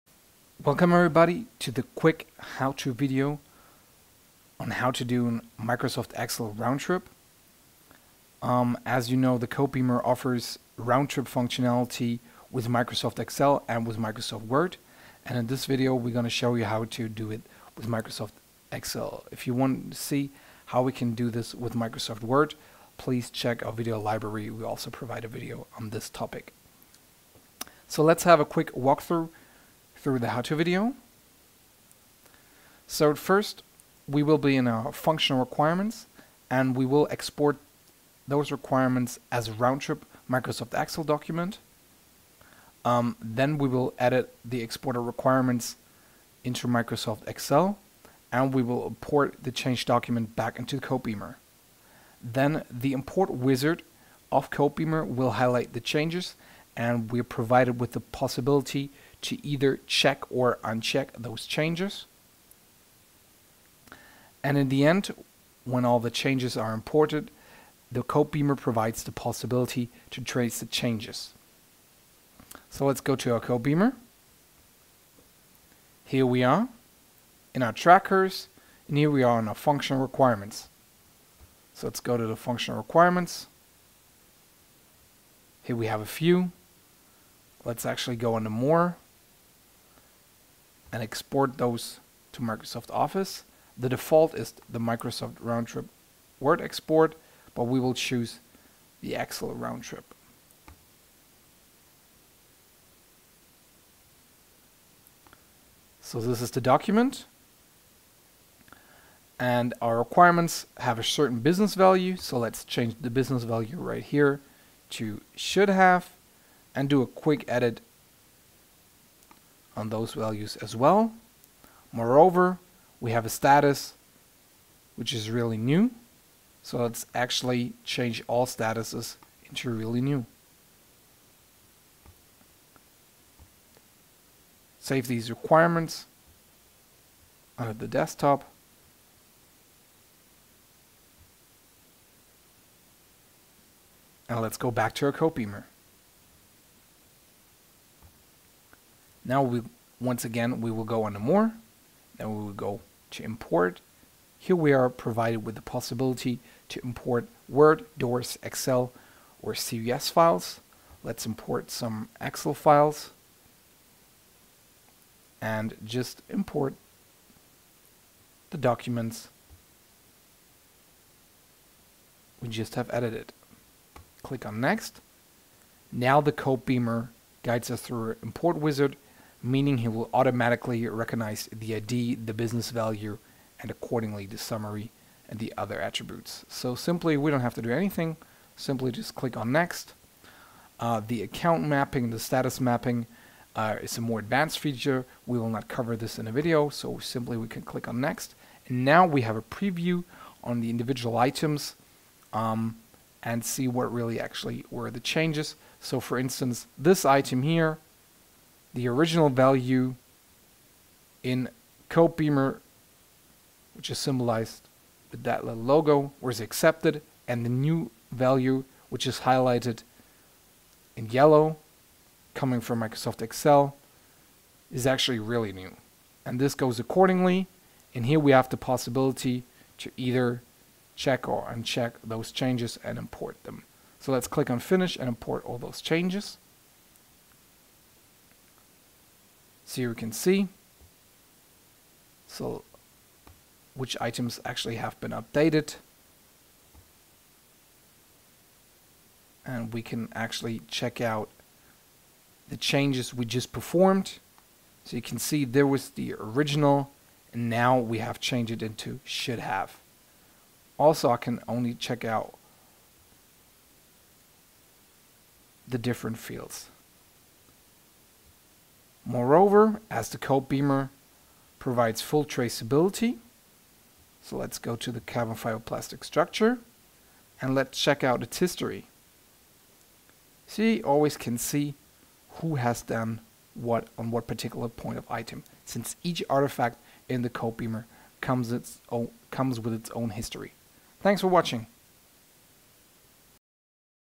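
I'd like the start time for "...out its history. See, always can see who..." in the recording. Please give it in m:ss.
4:38.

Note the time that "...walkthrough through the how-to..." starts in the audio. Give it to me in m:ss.
0:28.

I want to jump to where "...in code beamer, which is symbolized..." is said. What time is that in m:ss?
3:31.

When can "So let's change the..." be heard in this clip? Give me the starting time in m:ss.
1:52.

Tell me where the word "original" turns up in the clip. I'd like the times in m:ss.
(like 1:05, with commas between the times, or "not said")
3:28, 4:16.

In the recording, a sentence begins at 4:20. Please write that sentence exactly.
Also, I can only check out the different fields.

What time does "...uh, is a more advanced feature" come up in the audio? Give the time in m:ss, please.
3:13.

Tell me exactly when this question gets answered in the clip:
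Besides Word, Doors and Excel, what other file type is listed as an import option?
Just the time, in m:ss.
2:39.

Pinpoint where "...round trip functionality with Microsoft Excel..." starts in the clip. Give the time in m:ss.
0:10.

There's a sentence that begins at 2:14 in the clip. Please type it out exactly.
Save these requirements under the desktop.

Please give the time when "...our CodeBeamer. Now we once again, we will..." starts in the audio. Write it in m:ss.
2:25.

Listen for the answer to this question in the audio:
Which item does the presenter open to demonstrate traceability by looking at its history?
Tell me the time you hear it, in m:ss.
4:35.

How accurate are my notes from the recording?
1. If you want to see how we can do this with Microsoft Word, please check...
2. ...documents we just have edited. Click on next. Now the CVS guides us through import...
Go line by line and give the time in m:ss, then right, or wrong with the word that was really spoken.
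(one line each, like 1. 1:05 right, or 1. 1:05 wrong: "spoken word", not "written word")
1. 0:19 right
2. 2:48 wrong: "Beamer", not "CVS".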